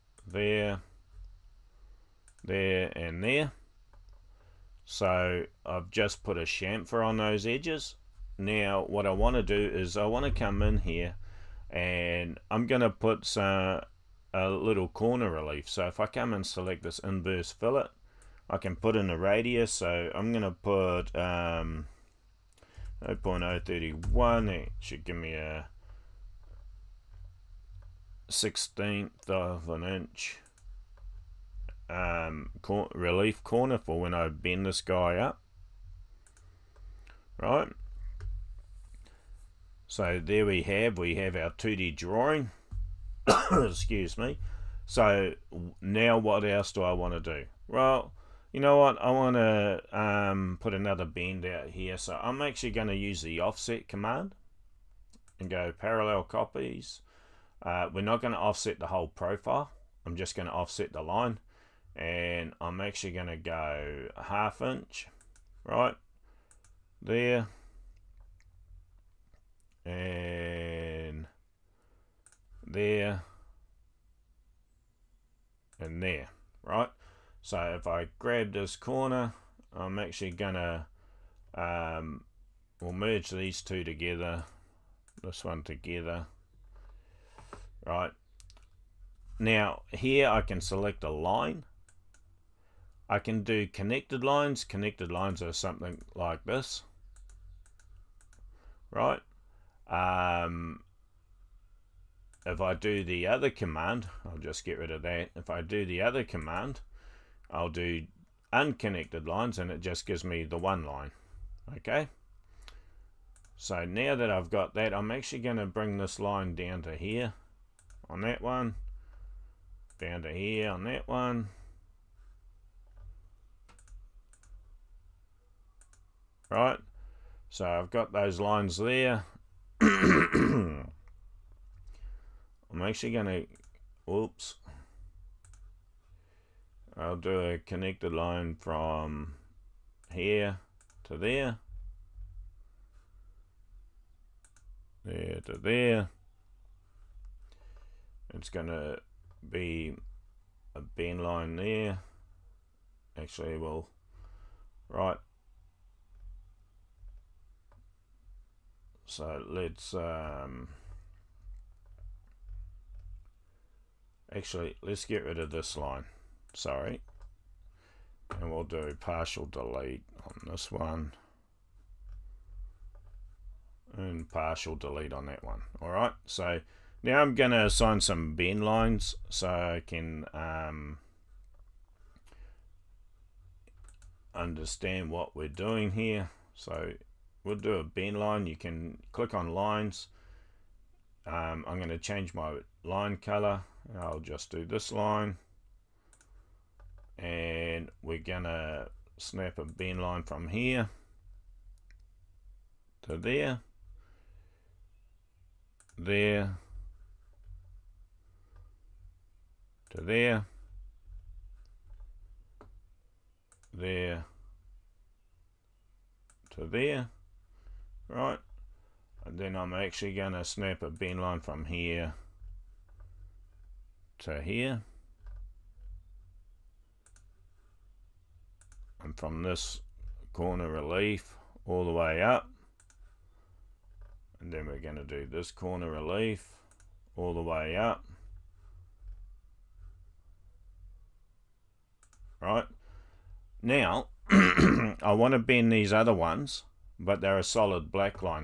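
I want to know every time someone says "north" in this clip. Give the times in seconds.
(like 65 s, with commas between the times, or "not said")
not said.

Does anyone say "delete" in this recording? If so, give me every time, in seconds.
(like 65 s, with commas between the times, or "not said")
169 s, 174 s.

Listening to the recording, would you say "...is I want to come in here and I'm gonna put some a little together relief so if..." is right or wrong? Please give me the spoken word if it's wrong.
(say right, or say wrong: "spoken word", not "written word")
wrong: "corner", not "together".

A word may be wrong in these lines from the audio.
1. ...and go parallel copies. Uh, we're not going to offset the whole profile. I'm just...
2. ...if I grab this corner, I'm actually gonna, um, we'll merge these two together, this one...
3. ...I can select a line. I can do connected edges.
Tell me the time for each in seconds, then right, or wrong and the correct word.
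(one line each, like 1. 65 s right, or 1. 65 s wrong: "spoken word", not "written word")
1. 55 s right
2. 77 s right
3. 90 s wrong: "lines", not "edges".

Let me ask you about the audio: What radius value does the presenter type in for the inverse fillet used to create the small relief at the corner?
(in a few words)
0.031.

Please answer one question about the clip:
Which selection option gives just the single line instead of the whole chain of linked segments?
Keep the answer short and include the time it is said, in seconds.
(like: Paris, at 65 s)
unconnected lines, at 108 s.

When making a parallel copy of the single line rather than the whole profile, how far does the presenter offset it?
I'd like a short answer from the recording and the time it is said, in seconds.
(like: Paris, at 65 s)
a half inch, at 64 s.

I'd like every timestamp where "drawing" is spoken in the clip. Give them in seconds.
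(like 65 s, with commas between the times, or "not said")
41 s.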